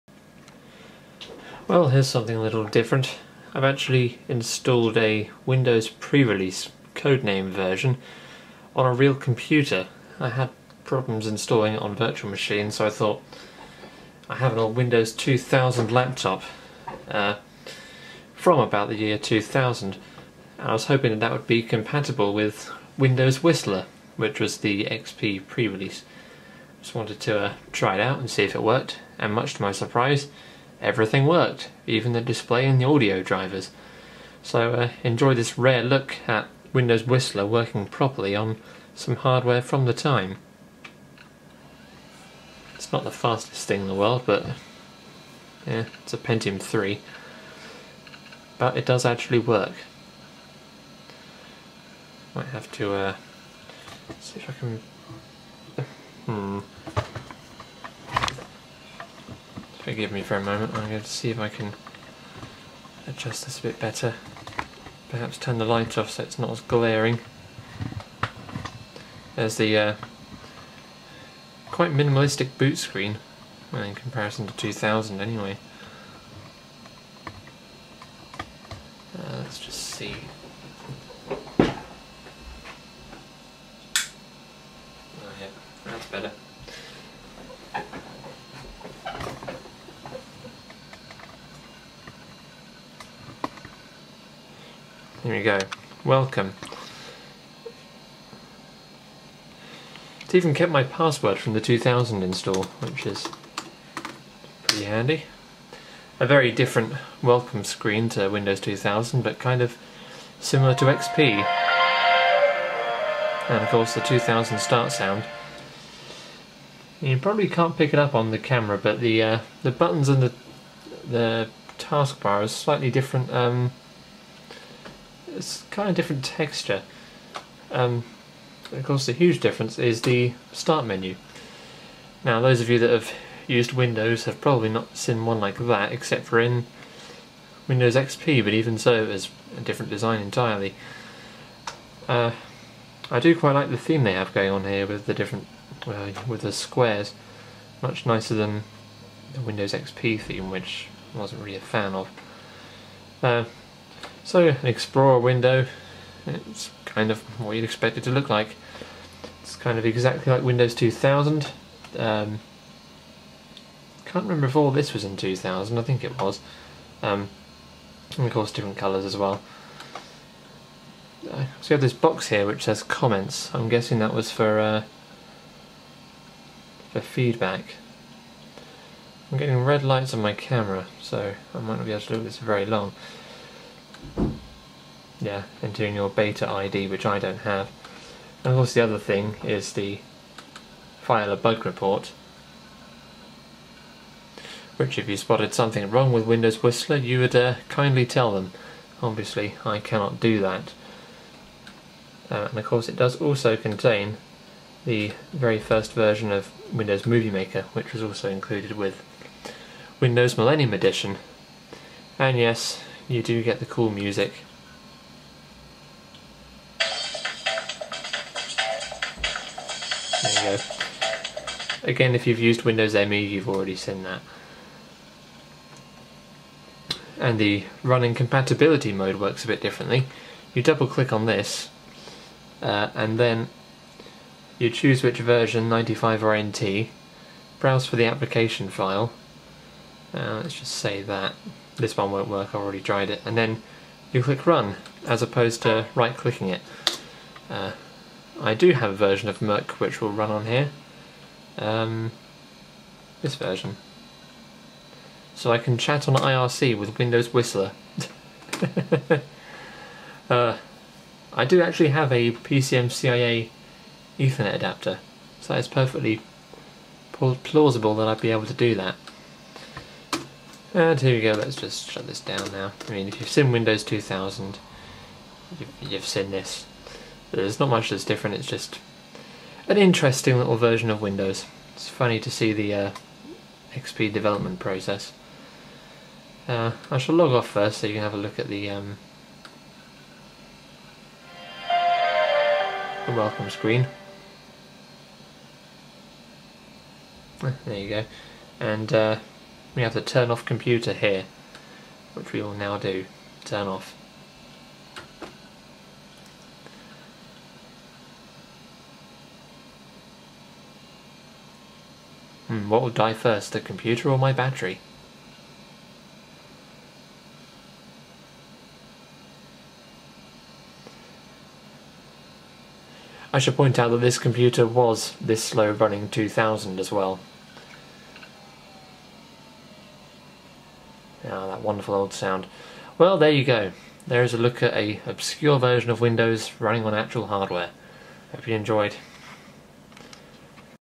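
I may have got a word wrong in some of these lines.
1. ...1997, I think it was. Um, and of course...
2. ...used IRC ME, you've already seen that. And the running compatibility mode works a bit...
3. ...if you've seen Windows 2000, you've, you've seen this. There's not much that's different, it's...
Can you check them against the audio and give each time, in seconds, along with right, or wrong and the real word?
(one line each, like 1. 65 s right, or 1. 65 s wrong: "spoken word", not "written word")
1. 165 s wrong: "2000", not "1997"
2. 222 s wrong: "Windows", not "IRC"
3. 273 s right.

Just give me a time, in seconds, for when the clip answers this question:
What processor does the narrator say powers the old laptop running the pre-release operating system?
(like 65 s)
46 s.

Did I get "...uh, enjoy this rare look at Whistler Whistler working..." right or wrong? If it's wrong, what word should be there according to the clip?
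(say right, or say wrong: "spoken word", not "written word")
wrong: "Windows", not "Whistler".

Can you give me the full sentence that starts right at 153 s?
Uh, so an Explorer window, it's kind of what you'd expect it to look like.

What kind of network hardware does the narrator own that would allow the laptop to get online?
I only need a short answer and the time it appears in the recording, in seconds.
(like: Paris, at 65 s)
PCMCIA Ethernet adapter, at 262 s.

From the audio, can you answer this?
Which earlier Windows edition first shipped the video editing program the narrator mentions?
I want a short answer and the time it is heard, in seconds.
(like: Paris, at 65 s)
Windows Millennium Edition, at 209 s.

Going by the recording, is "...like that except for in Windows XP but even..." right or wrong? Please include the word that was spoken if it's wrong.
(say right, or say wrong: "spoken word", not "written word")
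right.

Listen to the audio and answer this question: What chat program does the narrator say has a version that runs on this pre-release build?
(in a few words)
mIRC.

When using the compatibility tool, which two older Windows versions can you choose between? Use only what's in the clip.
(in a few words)
95 or NT.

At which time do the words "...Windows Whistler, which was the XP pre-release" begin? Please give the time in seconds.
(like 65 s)
22 s.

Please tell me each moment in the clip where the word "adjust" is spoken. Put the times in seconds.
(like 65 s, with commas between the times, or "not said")
63 s.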